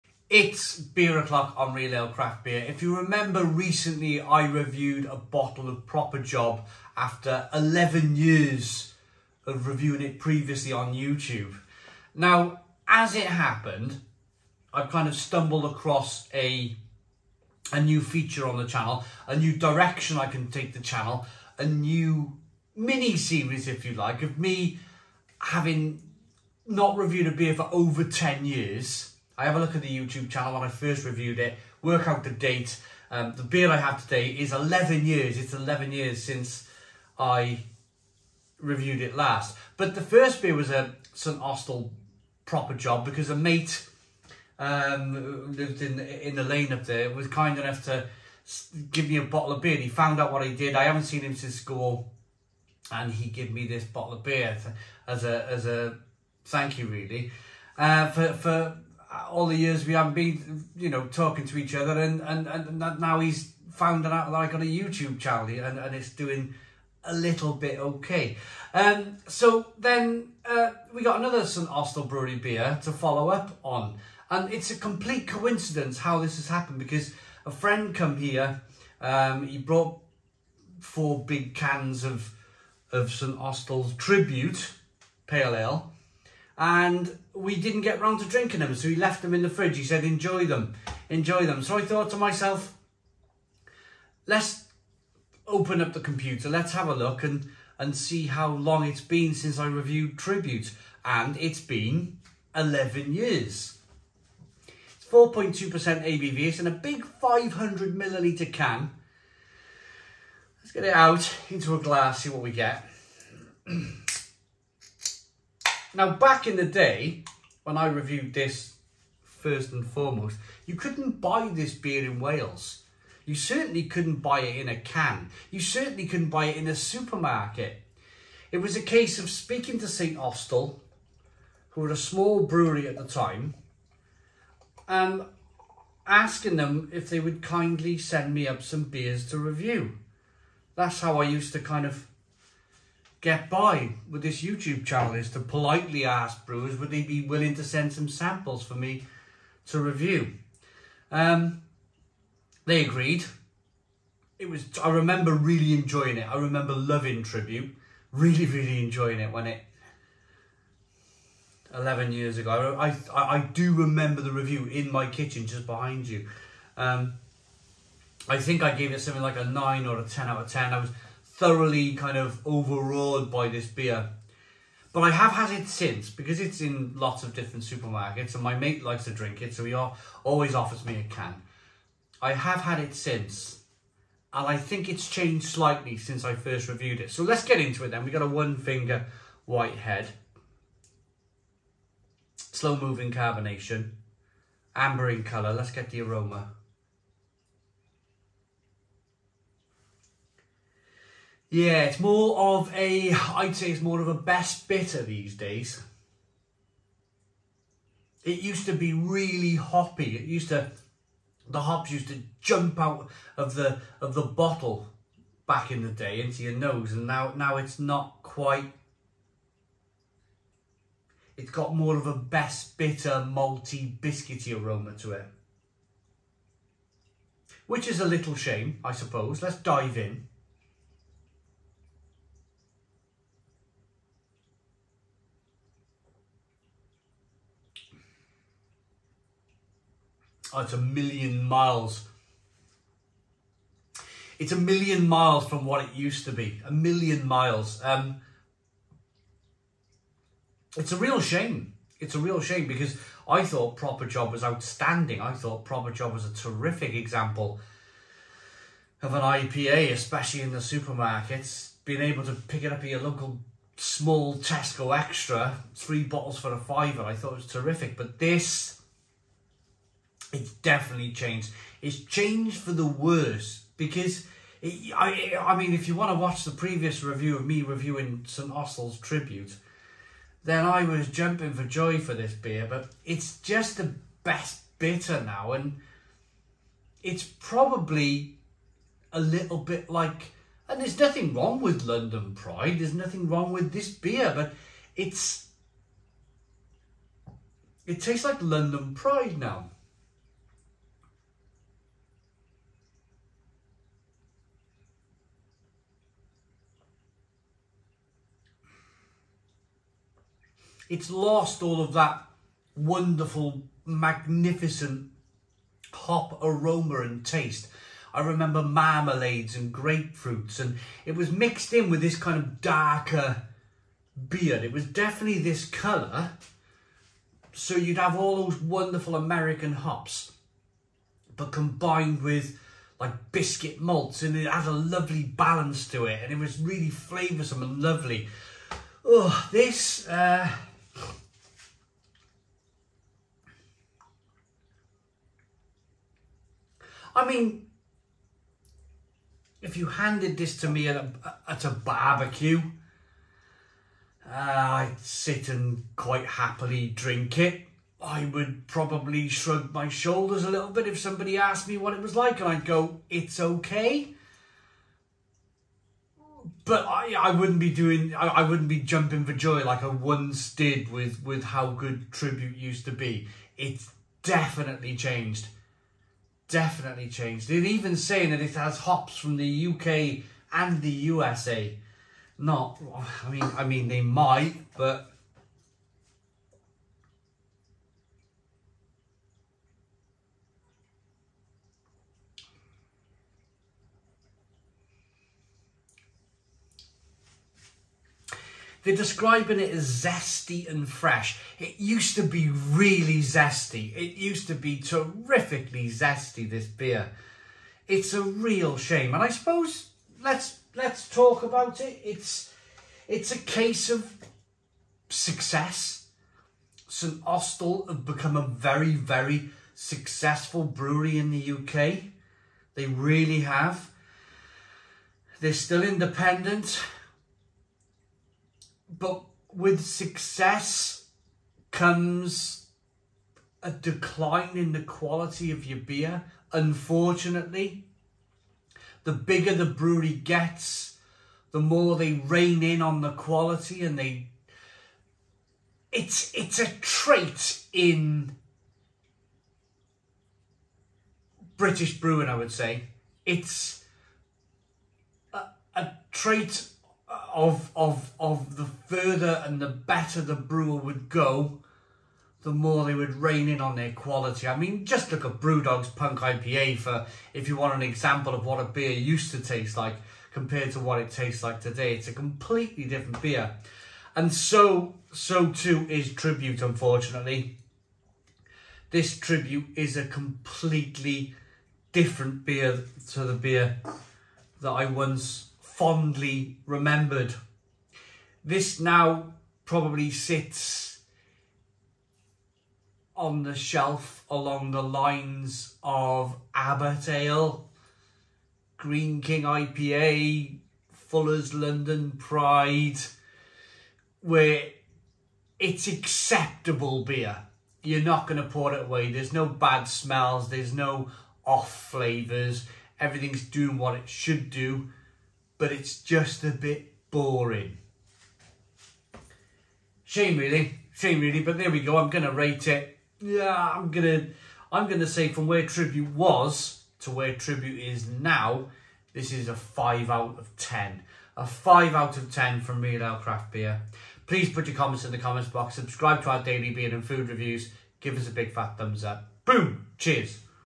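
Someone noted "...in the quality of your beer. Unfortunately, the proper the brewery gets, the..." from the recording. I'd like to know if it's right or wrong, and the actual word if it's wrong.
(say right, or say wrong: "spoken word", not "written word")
wrong: "bigger", not "proper".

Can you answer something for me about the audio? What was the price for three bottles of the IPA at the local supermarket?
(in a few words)
a fiver.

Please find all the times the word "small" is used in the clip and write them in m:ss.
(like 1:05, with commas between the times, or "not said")
2:11, 4:23.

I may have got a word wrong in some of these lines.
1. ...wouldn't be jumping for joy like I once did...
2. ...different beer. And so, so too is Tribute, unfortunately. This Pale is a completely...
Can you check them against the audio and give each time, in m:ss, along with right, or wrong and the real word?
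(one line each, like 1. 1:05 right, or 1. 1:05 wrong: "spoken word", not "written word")
1. 6:08 right
2. 7:52 wrong: "Tribute", not "Pale".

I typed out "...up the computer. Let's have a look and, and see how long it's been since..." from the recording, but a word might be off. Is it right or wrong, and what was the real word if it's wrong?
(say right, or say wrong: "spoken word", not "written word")
right.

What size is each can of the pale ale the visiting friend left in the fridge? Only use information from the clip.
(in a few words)
500 milliliters.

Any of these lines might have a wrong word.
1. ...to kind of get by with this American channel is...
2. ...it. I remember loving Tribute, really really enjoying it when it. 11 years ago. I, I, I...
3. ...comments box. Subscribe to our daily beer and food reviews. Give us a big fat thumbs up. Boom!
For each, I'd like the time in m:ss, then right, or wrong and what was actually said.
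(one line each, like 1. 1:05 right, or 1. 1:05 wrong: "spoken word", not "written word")
1. 2:21 wrong: "YouTube", not "American"
2. 2:36 right
3. 8:55 right.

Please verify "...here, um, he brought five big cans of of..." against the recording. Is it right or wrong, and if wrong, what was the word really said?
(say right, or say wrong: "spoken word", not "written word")
wrong: "four", not "five".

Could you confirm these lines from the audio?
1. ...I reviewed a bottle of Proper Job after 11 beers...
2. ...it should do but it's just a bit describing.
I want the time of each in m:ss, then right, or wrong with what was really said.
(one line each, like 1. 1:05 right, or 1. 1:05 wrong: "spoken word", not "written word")
1. 0:04 wrong: "years", not "beers"
2. 8:33 wrong: "boring", not "describing".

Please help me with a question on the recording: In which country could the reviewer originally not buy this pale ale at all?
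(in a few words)
Wales.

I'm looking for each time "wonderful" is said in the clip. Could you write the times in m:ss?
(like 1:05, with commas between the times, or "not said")
5:12, 5:28.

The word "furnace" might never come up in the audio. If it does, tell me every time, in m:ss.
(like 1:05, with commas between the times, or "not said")
not said.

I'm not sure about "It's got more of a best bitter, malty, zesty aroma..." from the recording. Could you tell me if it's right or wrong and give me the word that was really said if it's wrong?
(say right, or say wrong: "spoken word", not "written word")
wrong: "biscuity", not "zesty".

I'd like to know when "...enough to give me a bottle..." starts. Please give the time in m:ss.
0:47.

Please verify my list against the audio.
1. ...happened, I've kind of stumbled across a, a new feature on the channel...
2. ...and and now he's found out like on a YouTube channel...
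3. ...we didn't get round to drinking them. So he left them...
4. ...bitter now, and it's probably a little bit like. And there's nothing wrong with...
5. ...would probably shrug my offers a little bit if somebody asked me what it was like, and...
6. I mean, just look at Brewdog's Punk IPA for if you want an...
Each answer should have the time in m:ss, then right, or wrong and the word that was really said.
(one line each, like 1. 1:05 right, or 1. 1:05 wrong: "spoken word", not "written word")
1. 0:13 right
2. 1:02 right
3. 1:27 right
4. 4:44 right
5. 5:58 wrong: "shoulders", not "offers"
6. 7:44 right.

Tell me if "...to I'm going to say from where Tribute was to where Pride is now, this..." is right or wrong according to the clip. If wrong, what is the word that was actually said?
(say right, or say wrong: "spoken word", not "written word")
wrong: "Tribute", not "Pride".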